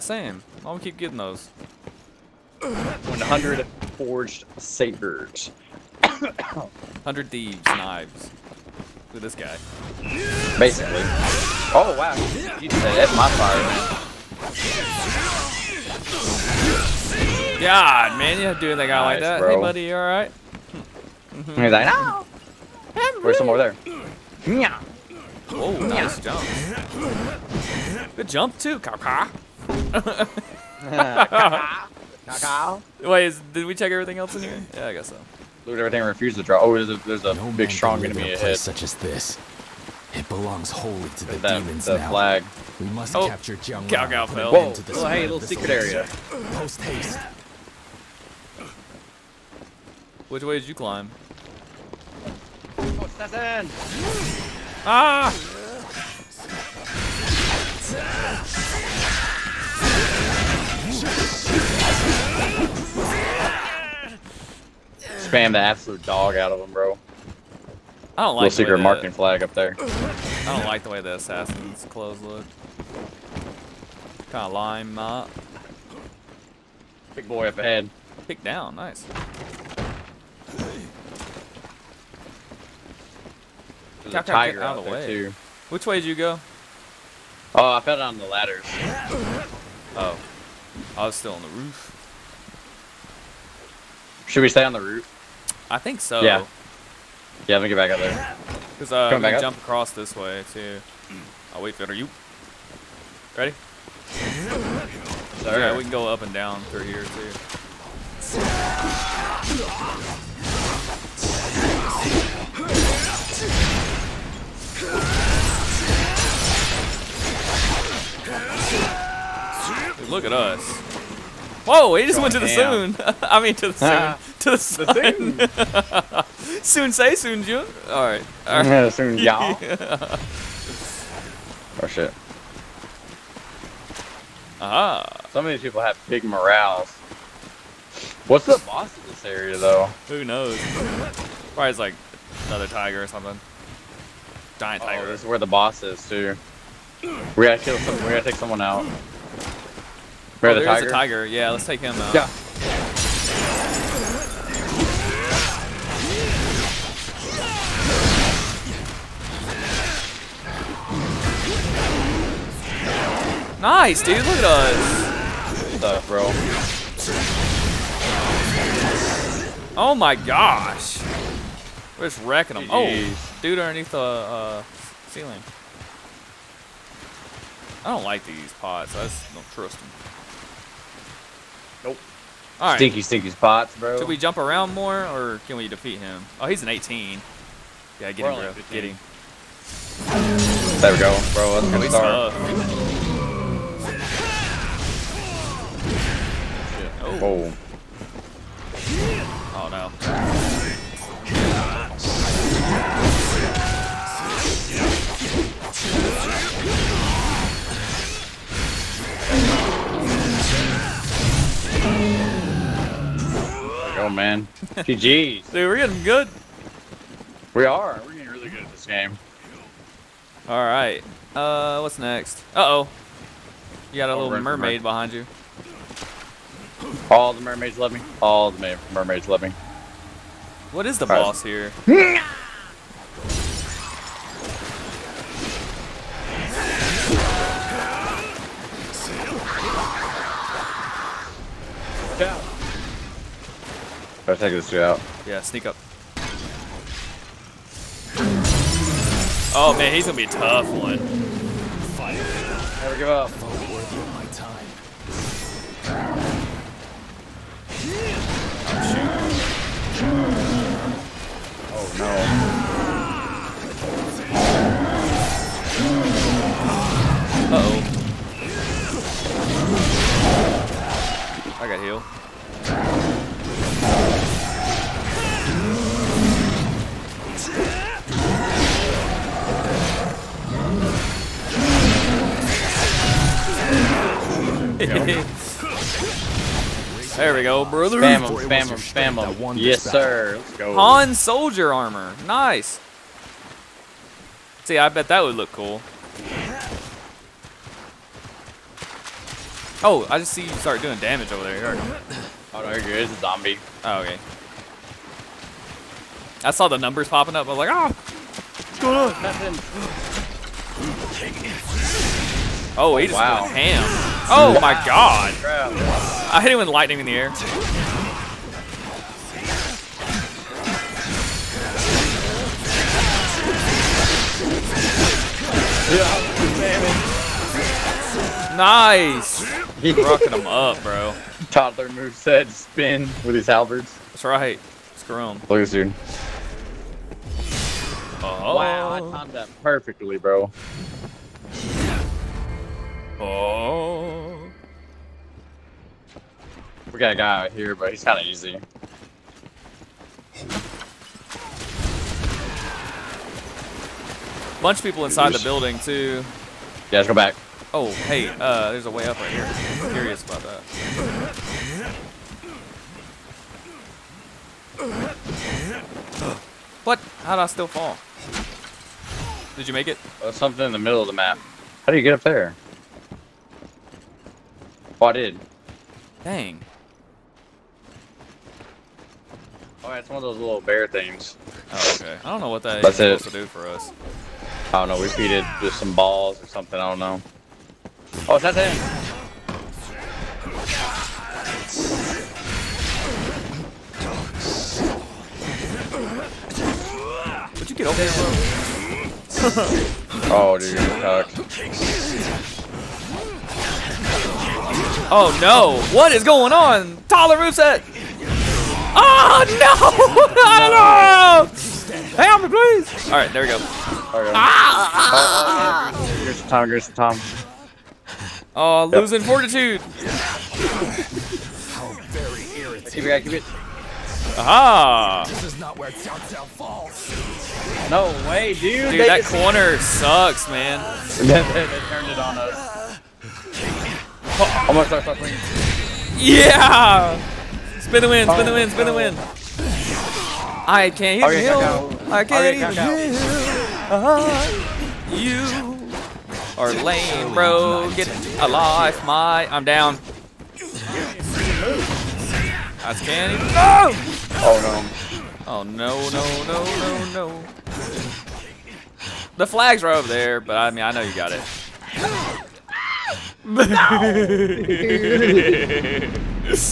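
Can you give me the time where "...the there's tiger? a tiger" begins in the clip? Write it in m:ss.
2:30.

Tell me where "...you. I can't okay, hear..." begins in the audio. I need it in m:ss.
7:21.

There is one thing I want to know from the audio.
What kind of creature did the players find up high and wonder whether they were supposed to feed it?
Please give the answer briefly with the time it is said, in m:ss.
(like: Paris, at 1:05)
Bear, at 6:20.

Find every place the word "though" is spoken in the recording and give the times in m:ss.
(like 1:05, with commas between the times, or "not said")
2:19.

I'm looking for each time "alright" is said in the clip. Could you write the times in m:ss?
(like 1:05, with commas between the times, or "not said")
0:19, 6:53.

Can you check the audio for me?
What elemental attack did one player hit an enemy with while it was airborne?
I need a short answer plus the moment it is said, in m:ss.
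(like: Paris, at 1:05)
Lightning, at 5:16.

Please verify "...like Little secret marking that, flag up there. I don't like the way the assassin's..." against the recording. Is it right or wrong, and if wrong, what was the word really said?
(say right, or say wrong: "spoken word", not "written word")
right.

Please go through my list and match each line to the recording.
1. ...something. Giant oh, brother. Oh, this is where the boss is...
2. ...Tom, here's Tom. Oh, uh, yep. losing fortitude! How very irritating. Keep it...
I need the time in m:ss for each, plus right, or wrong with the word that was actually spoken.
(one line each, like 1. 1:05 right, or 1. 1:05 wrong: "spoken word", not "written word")
1. 2:23 wrong: "tiger", not "brother"
2. 6:56 right.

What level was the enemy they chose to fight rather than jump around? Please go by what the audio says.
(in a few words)
18.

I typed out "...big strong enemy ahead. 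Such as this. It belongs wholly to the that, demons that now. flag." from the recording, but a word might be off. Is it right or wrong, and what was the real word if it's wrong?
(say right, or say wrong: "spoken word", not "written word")
right.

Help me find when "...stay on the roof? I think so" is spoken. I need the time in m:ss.
1:34.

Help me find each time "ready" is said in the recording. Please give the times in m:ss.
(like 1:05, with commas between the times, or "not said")
1:43.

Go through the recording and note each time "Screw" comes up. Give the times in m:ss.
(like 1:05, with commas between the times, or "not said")
5:34.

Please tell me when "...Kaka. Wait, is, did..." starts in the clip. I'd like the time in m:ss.
0:32.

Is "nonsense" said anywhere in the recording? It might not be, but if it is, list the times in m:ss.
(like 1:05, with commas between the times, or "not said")
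not said.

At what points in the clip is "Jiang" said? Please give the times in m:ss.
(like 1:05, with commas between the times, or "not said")
0:43.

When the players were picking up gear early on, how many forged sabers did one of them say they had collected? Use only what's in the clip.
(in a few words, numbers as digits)
100.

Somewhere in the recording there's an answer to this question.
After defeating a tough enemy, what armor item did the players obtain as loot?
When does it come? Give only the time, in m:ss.
4:50.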